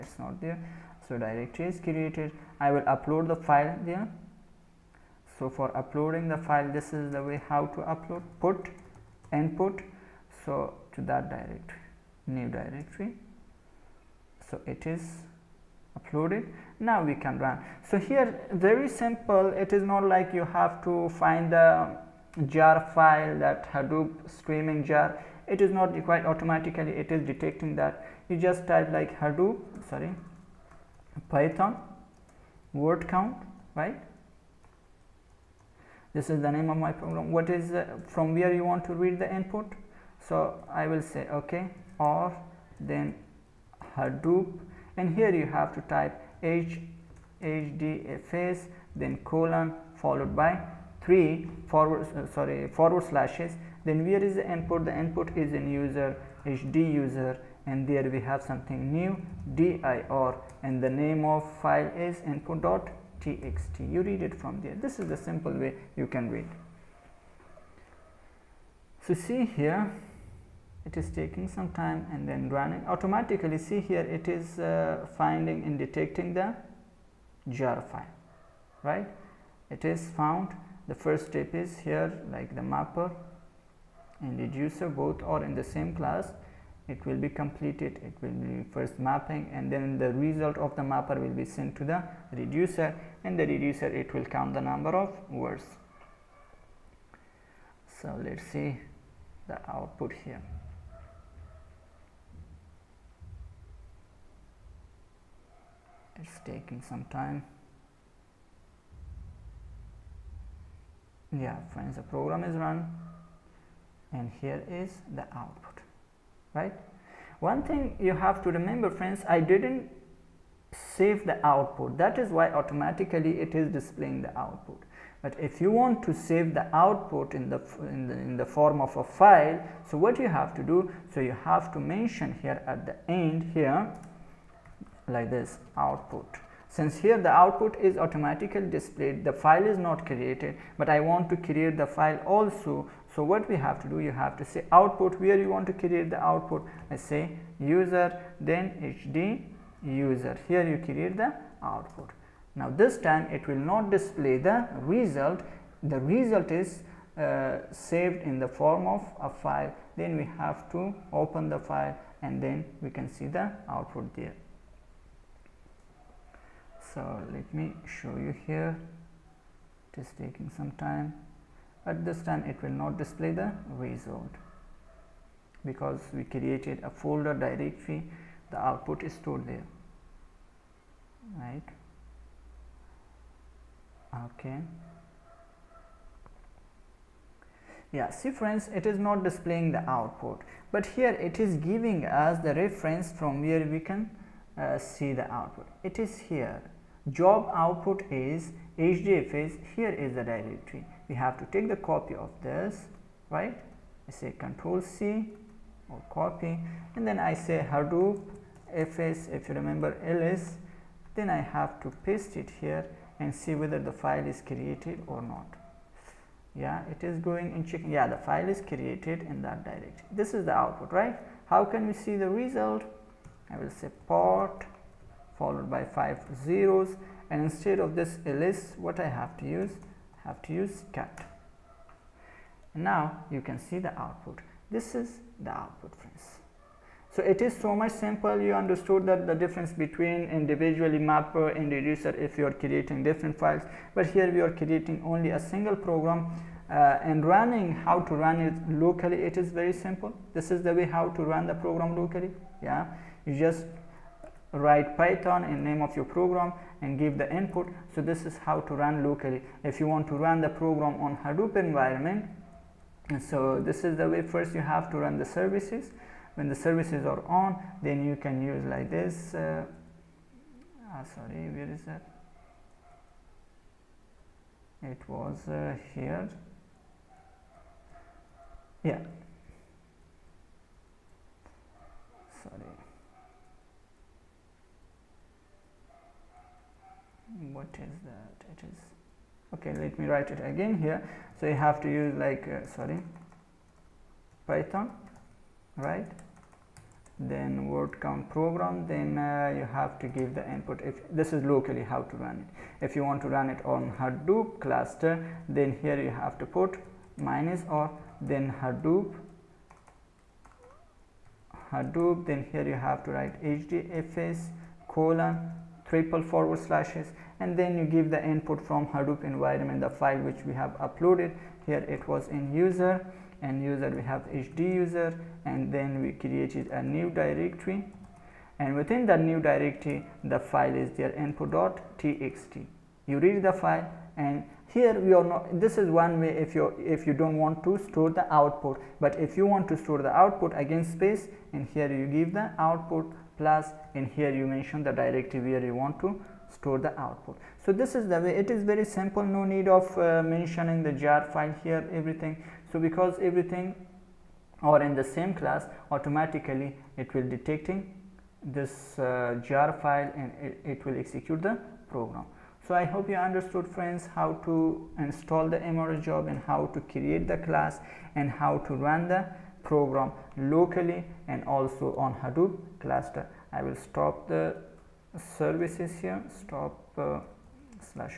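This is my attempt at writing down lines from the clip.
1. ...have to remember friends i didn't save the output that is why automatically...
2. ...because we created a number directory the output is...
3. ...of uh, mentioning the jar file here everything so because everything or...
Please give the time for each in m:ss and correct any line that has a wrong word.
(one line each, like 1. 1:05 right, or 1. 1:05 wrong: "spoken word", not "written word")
1. 1:58 right
2. 2:55 wrong: "folder", not "number"
3. 5:49 right.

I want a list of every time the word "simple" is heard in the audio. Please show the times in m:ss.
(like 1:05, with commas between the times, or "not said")
0:18, 1:05, 3:57, 4:09, 5:48.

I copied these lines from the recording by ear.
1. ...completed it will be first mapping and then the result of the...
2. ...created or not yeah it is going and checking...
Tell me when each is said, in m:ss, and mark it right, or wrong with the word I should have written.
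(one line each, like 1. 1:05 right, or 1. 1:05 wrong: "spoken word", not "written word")
1. 1:27 right
2. 3:34 right.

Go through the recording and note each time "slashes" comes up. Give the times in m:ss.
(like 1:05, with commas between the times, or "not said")
0:53, 5:16.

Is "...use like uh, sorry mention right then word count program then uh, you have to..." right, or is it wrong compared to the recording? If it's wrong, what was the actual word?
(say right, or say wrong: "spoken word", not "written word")
wrong: "python", not "mention".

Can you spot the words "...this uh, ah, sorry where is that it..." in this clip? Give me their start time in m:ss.
4:28.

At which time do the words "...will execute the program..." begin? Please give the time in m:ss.
6:00.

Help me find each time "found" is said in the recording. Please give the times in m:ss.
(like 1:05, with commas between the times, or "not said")
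1:20.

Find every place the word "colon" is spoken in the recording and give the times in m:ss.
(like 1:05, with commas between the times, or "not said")
0:49, 5:14.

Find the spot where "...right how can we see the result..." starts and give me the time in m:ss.
3:40.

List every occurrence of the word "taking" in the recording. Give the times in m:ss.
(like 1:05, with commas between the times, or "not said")
1:11, 1:46, 2:50.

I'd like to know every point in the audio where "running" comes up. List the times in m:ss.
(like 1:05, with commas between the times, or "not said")
1:12, 4:07.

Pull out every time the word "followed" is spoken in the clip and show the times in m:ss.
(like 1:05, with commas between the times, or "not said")
0:49, 3:45.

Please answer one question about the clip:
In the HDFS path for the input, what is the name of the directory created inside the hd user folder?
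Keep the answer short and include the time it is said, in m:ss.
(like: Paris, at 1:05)
new dir, at 0:58.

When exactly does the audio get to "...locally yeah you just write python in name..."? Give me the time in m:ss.
4:11.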